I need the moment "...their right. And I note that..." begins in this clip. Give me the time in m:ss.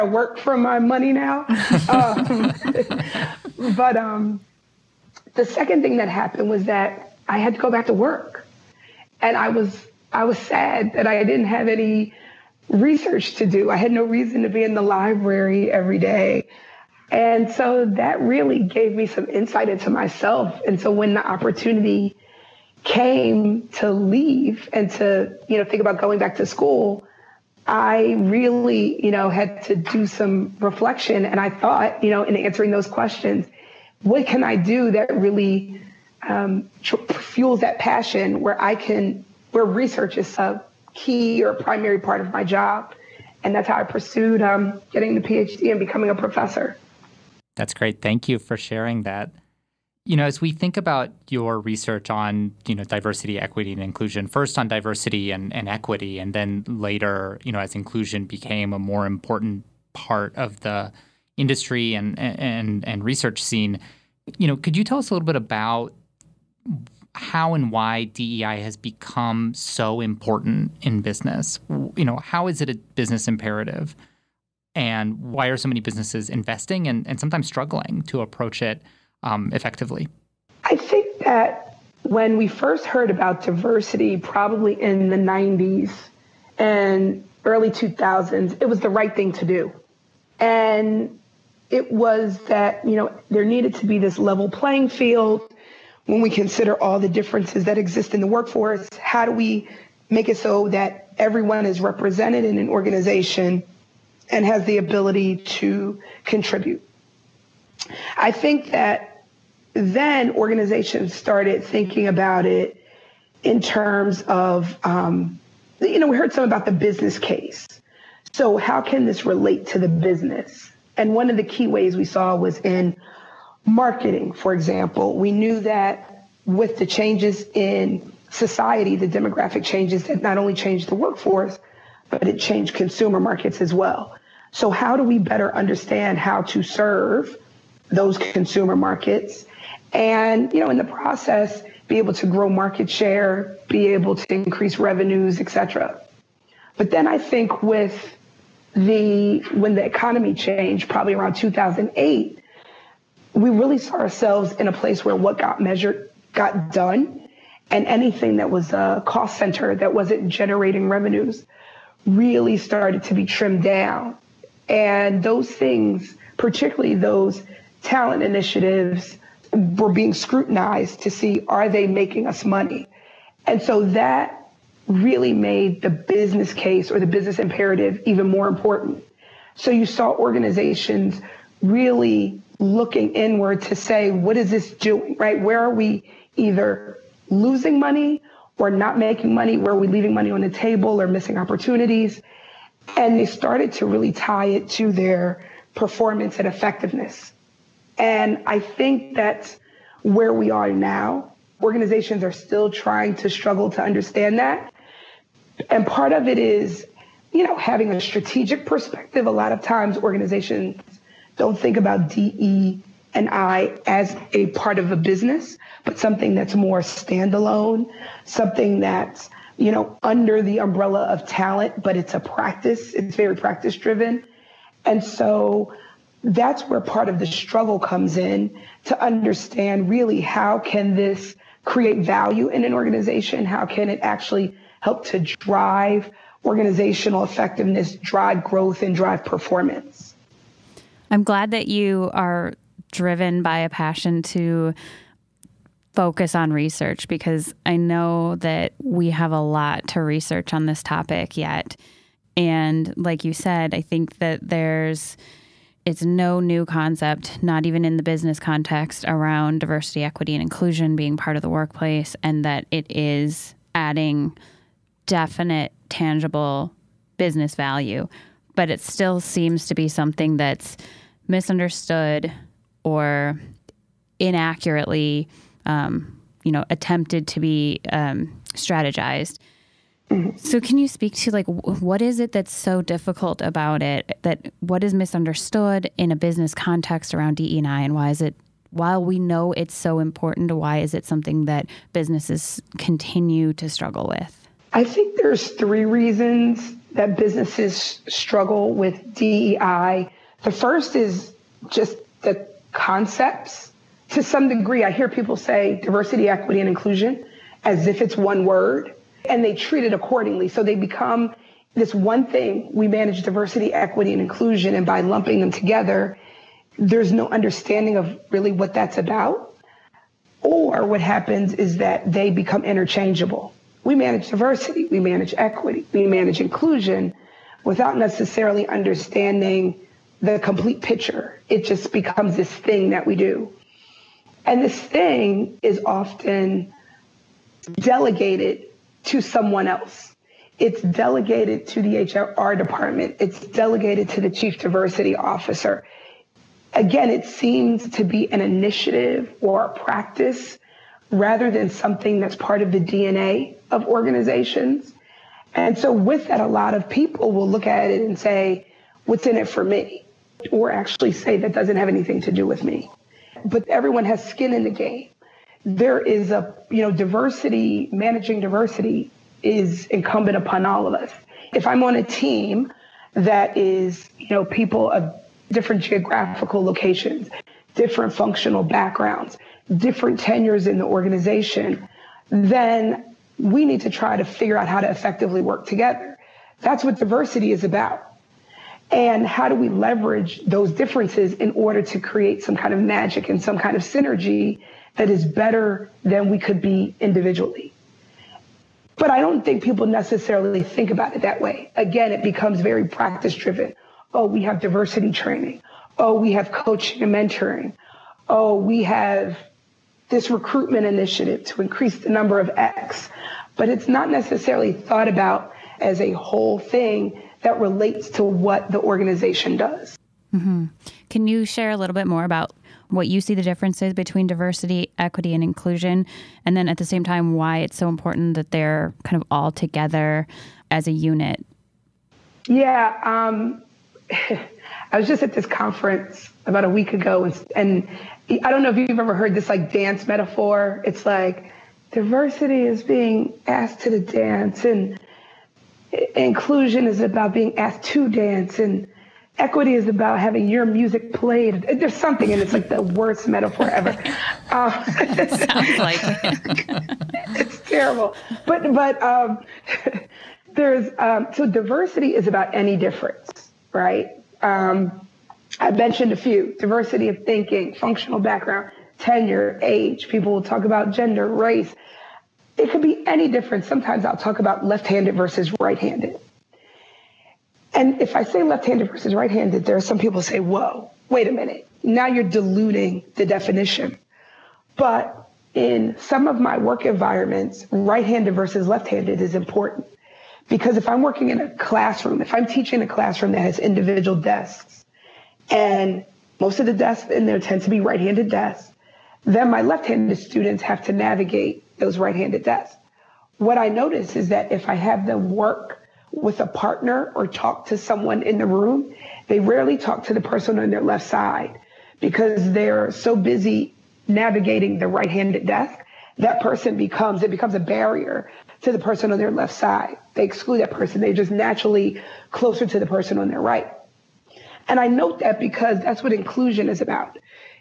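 8:43.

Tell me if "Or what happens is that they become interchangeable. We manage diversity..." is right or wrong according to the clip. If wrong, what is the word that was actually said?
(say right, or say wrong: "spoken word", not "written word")
right.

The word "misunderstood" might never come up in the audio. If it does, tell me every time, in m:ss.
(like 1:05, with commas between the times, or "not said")
4:31, 4:44.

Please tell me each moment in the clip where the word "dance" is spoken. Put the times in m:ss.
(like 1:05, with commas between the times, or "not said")
7:19, 7:23, 7:28.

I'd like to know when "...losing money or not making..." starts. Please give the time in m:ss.
3:07.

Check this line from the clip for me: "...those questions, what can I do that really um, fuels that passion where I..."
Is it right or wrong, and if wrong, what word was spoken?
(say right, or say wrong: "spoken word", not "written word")
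right.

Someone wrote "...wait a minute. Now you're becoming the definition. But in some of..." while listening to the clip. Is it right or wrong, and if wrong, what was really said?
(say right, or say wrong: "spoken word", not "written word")
wrong: "diluting", not "becoming".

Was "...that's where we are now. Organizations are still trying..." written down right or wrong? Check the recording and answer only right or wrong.
right.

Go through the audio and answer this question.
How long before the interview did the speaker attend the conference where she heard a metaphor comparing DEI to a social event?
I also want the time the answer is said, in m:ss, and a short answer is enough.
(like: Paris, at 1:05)
about a week, at 7:16.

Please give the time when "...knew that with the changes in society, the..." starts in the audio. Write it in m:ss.
2:05.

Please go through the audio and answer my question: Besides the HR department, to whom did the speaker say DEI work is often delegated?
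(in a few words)
the chief diversity officer.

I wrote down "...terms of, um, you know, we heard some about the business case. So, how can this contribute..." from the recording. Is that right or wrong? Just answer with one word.
wrong.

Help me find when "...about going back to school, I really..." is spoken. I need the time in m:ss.
0:25.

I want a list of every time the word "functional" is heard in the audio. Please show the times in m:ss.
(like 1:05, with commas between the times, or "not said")
6:18, 7:47.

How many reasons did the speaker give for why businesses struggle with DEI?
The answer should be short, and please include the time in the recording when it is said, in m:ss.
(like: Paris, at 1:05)
3, at 4:55.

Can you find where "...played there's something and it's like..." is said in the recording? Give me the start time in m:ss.
7:31.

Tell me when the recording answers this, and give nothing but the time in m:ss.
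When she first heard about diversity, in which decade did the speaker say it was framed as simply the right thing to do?
1:25.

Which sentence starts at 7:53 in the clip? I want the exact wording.
Sometimes I'll talk about left handed versus right handed.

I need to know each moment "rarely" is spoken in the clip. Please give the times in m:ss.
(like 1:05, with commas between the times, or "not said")
8:29.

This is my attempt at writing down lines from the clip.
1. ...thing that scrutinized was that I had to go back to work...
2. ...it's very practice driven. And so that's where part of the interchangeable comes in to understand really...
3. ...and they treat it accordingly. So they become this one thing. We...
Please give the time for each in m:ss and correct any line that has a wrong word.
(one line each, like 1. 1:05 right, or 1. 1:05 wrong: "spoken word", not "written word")
1. 0:05 wrong: "happened", not "scrutinized"
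2. 3:42 wrong: "struggle", not "interchangeable"
3. 5:09 right.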